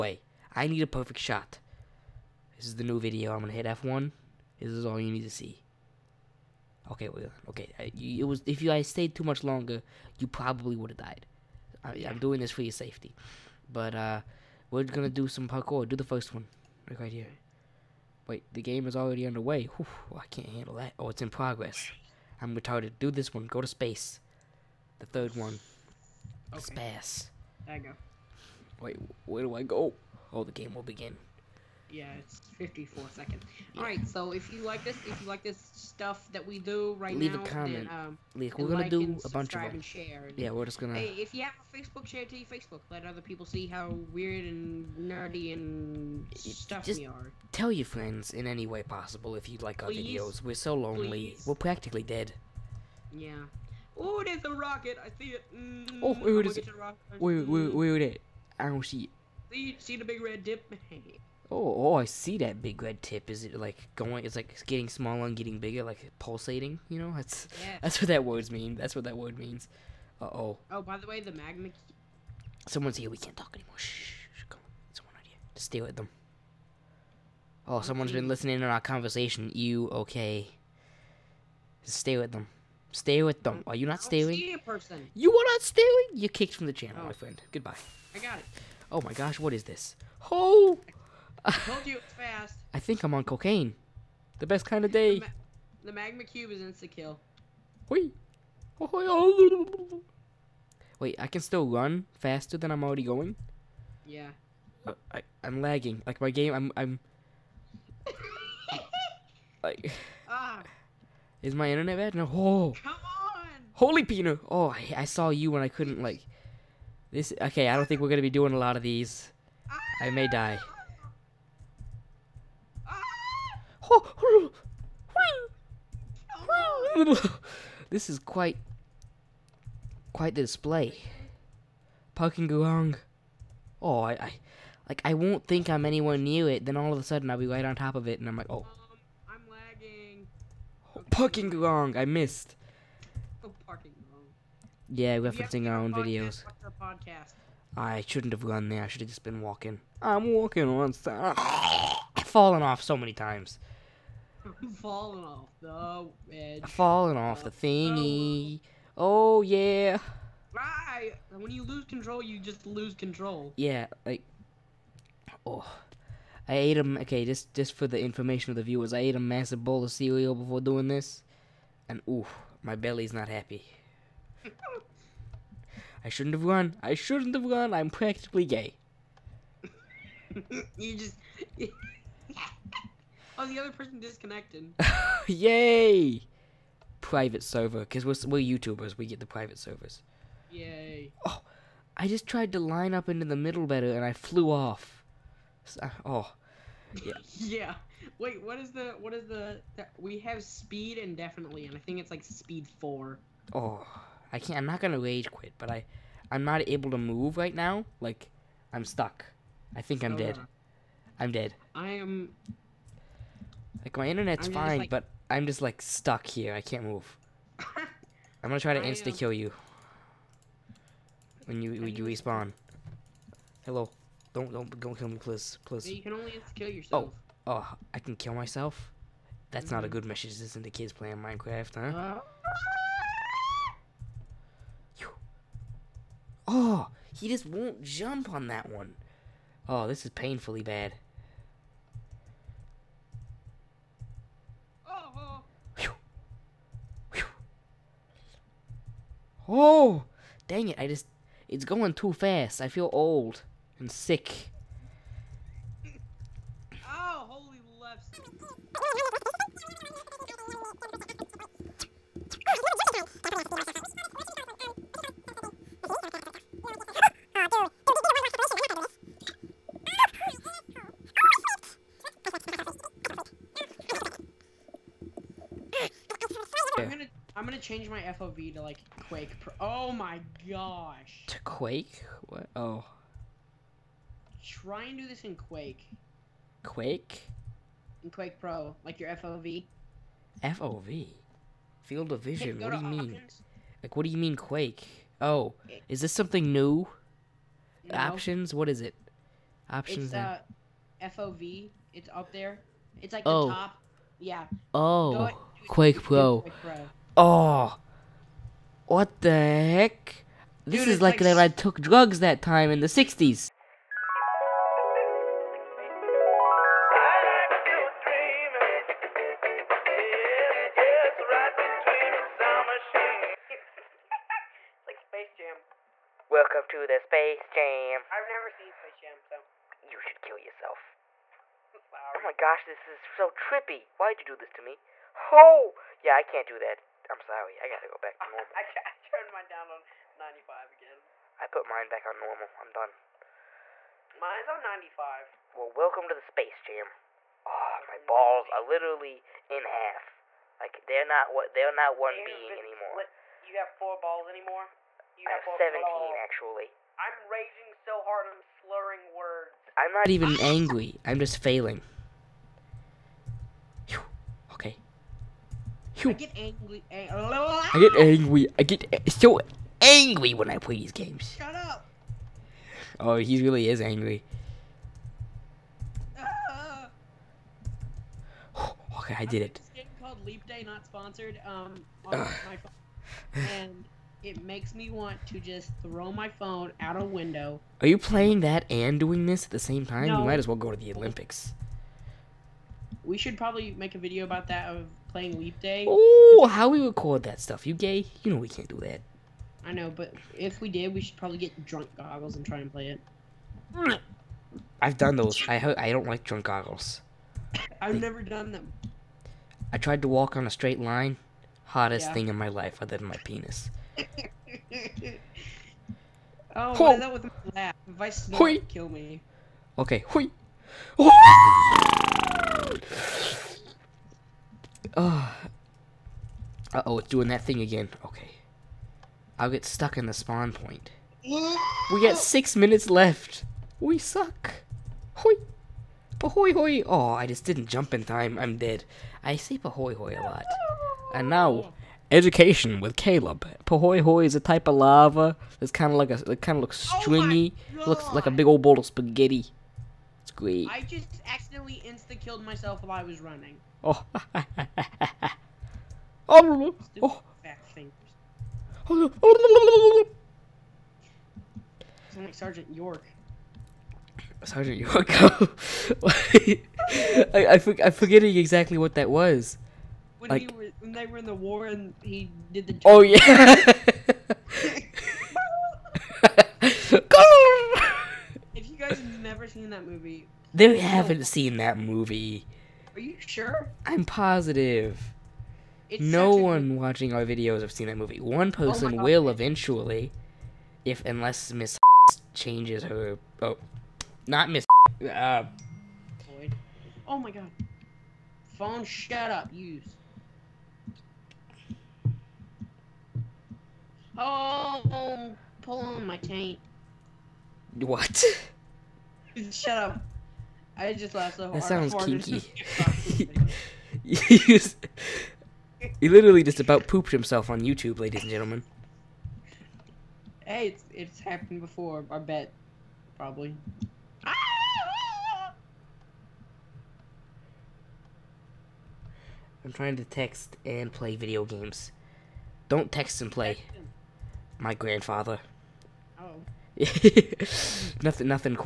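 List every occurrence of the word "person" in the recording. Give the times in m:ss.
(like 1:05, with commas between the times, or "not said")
1:24, 3:03, 8:08.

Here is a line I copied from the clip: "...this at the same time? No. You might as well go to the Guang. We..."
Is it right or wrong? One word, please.
wrong.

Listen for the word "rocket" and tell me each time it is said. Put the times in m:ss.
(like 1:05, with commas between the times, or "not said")
0:54.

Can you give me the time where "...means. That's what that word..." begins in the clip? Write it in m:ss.
1:08.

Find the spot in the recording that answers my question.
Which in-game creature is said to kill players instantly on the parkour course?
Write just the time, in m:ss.
1:35.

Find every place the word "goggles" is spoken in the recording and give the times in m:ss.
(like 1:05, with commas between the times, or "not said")
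6:41, 6:46.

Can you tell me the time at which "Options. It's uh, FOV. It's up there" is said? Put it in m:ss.
4:59.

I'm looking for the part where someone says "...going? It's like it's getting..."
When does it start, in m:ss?
1:03.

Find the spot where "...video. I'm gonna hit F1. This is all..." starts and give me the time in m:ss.
0:02.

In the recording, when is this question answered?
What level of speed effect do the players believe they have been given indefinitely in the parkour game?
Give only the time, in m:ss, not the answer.
3:22.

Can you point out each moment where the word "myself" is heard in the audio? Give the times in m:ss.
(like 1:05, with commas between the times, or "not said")
3:48, 7:32.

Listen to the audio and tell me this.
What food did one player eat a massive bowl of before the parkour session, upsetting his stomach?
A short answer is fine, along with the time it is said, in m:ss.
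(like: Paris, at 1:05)
Cereal, at 2:49.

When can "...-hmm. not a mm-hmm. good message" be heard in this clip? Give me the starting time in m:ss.
3:49.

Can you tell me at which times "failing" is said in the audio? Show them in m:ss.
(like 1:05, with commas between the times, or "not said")
6:01.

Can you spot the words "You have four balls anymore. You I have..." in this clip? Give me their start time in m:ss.
5:53.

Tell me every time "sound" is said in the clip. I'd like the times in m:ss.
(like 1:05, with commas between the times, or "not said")
7:42, 8:31.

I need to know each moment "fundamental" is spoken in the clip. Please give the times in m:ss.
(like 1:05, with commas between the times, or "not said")
not said.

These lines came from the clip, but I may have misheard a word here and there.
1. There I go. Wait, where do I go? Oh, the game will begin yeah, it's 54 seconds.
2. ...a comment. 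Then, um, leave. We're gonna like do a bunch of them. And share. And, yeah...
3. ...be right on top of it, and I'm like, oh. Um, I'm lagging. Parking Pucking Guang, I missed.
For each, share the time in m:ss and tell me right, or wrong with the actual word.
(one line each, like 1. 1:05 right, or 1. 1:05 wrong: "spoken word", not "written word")
1. 0:27 right
2. 0:37 right
3. 2:17 right.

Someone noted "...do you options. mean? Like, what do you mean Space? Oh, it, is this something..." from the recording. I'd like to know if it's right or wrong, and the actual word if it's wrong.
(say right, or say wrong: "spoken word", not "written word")
wrong: "Quake", not "Space".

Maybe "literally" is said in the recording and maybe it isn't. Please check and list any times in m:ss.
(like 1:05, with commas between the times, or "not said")
5:48, 8:36.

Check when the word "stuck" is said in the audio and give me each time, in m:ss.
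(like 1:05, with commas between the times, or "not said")
3:28, 3:35, 7:09.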